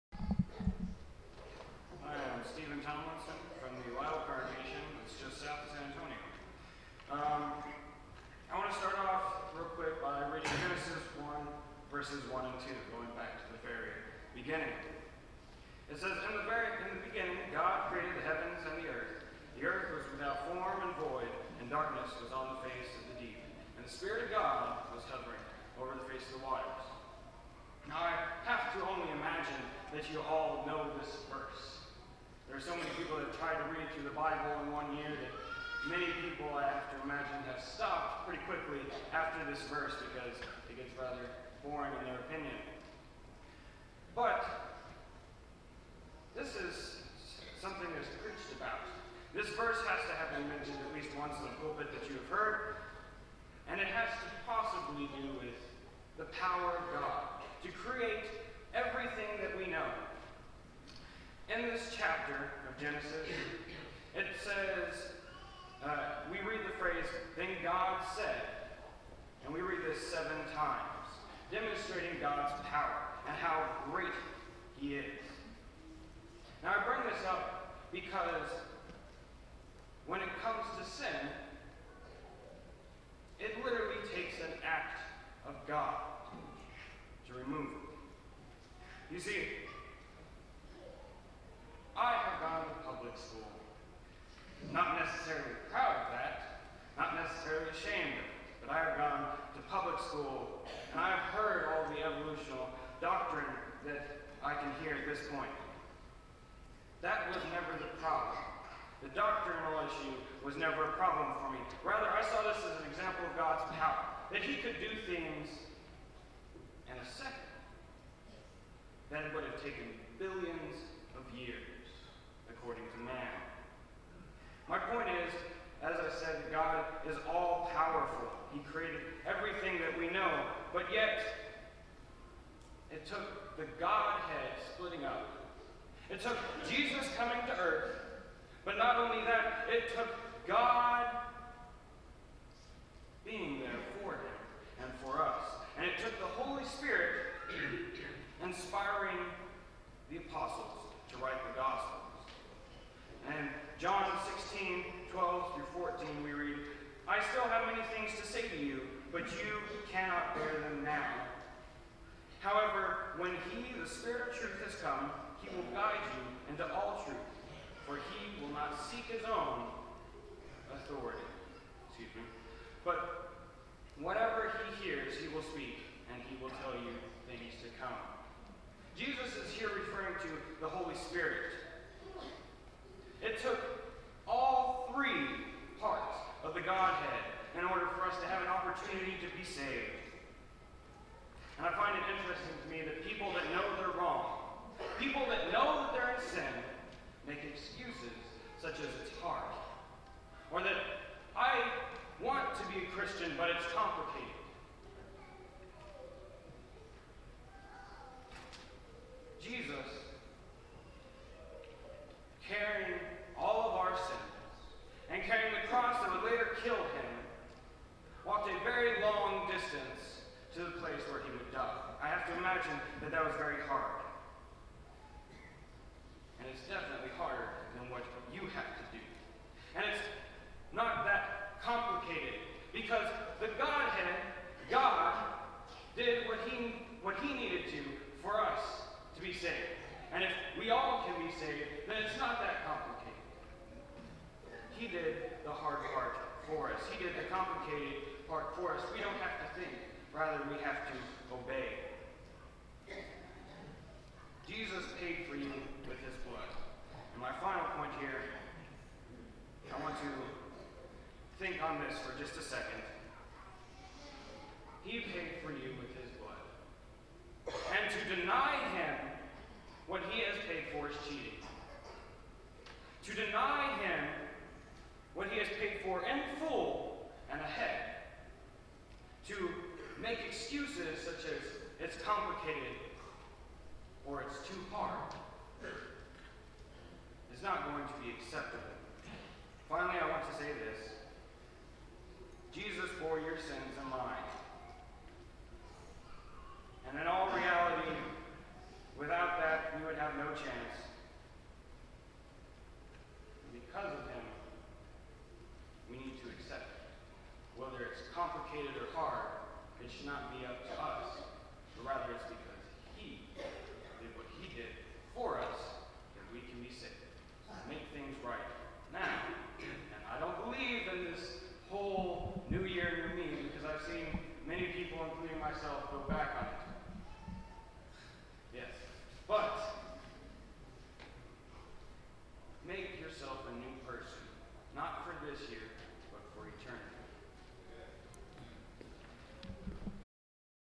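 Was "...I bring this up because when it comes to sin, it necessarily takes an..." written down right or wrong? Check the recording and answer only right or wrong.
wrong.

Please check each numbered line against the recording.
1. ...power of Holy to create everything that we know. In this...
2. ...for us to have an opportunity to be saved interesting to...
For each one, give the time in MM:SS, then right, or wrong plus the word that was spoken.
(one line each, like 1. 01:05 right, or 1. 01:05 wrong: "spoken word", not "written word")
1. 00:56 wrong: "God", not "Holy"
2. 03:07 right.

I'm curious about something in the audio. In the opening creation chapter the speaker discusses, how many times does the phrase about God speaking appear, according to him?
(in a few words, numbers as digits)
7.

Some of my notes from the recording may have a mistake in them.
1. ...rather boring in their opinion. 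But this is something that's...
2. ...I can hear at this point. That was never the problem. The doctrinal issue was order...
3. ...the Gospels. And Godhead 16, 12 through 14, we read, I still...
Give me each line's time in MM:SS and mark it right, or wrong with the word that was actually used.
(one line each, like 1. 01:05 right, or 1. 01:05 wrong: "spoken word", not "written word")
1. 00:40 right
2. 01:44 wrong: "never", not "order"
3. 02:31 wrong: "John", not "Godhead".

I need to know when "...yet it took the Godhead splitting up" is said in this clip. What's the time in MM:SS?
02:10.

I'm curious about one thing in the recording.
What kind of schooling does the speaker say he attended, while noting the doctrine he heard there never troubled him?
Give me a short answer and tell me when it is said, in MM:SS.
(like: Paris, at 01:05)
Public school, at 01:32.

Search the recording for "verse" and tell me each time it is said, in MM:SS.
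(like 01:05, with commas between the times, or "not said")
00:11, 00:31, 00:39, 00:49.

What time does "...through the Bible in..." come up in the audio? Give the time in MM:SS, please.
00:33.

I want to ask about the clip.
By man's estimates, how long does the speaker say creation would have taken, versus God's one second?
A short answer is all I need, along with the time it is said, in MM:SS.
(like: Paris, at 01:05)
Billions of years, at 02:00.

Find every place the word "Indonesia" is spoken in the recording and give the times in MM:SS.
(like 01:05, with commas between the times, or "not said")
not said.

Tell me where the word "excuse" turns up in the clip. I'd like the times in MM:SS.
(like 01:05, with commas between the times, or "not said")
02:51, 03:17.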